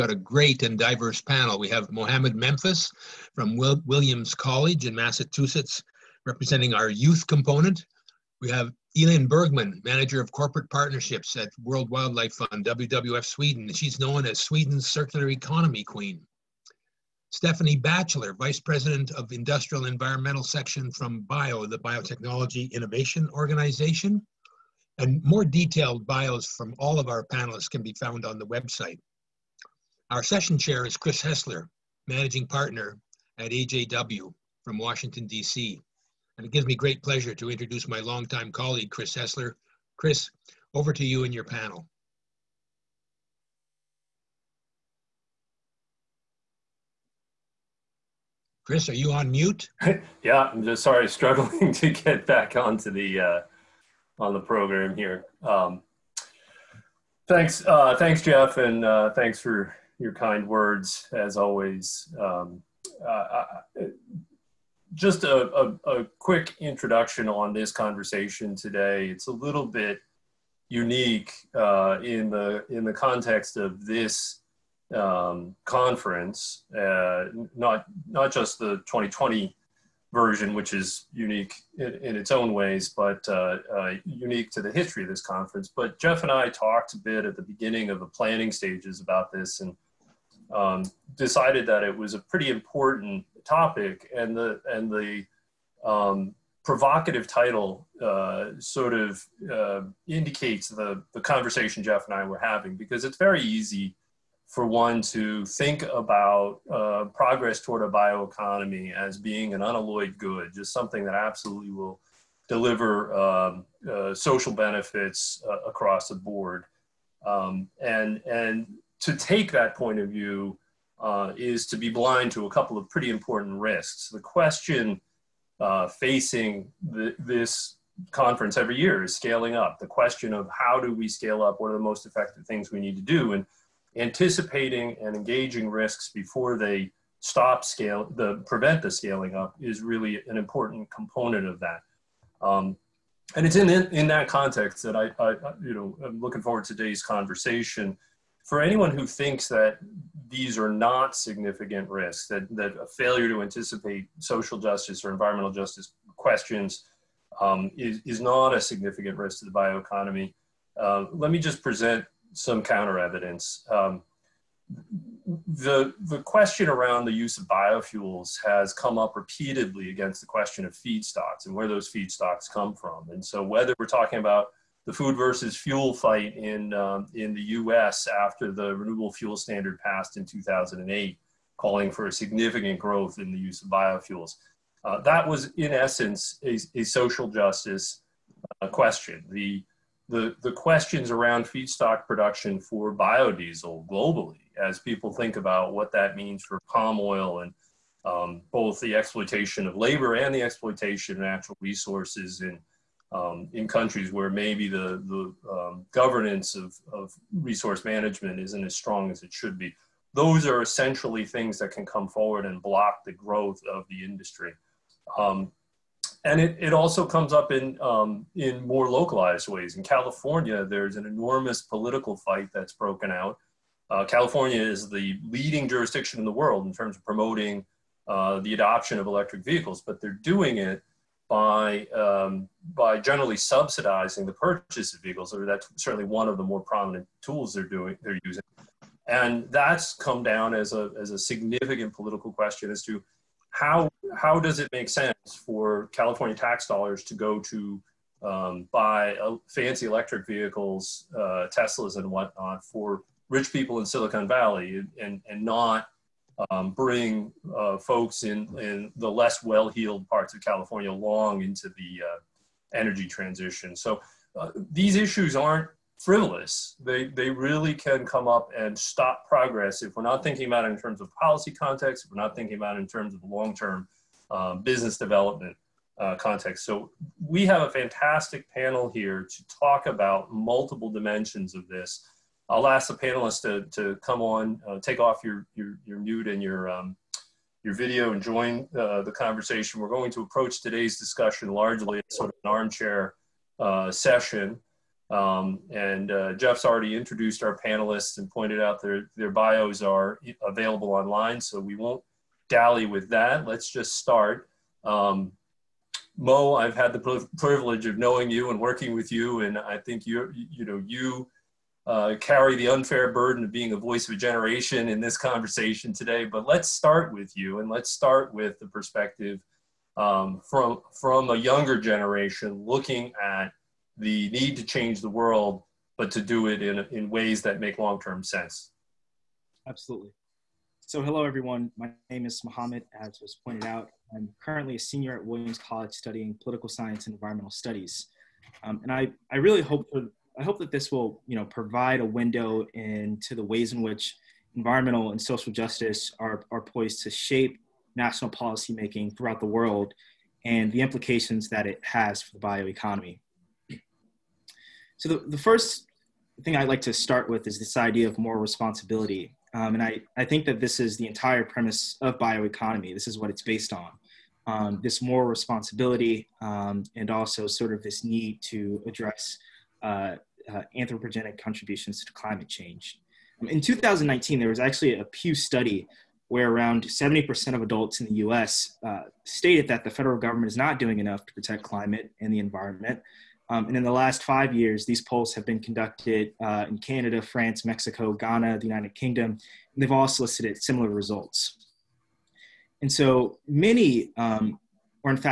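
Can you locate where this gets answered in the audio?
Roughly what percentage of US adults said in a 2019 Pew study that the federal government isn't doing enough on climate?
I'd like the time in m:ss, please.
6:16.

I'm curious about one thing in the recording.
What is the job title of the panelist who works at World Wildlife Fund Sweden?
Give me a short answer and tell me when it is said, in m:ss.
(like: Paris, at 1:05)
Manager of Corporate Partnerships, at 0:09.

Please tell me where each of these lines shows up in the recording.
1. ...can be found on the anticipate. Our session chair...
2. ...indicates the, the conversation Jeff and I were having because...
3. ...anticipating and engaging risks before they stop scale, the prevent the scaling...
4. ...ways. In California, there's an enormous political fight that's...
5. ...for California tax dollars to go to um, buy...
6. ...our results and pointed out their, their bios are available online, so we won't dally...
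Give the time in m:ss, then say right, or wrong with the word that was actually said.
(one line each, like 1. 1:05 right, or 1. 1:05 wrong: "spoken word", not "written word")
1. 0:27 wrong: "website", not "anticipate"
2. 1:40 right
3. 2:13 right
4. 3:39 right
5. 4:05 right
6. 4:57 wrong: "panelists", not "results".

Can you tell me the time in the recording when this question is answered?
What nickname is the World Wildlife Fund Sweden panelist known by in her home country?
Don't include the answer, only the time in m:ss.
0:14.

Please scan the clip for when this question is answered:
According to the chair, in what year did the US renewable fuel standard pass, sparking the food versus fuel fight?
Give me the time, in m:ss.
3:00.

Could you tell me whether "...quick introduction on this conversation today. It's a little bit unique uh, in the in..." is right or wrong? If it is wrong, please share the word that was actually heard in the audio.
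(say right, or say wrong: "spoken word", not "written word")
right.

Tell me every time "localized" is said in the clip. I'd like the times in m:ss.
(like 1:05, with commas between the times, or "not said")
3:38.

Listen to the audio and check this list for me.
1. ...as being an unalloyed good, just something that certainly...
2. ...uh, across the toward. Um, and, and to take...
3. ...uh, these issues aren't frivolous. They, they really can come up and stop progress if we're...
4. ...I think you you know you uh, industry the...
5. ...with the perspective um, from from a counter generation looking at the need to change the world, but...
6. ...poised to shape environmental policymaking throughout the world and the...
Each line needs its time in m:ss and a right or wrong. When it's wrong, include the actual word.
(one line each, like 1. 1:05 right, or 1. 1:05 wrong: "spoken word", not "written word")
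1. 1:48 wrong: "absolutely", not "certainly"
2. 1:55 wrong: "board", not "toward"
3. 4:24 right
4. 5:09 wrong: "carry", not "industry"
5. 5:18 wrong: "younger", not "counter"
6. 5:46 wrong: "national", not "environmental".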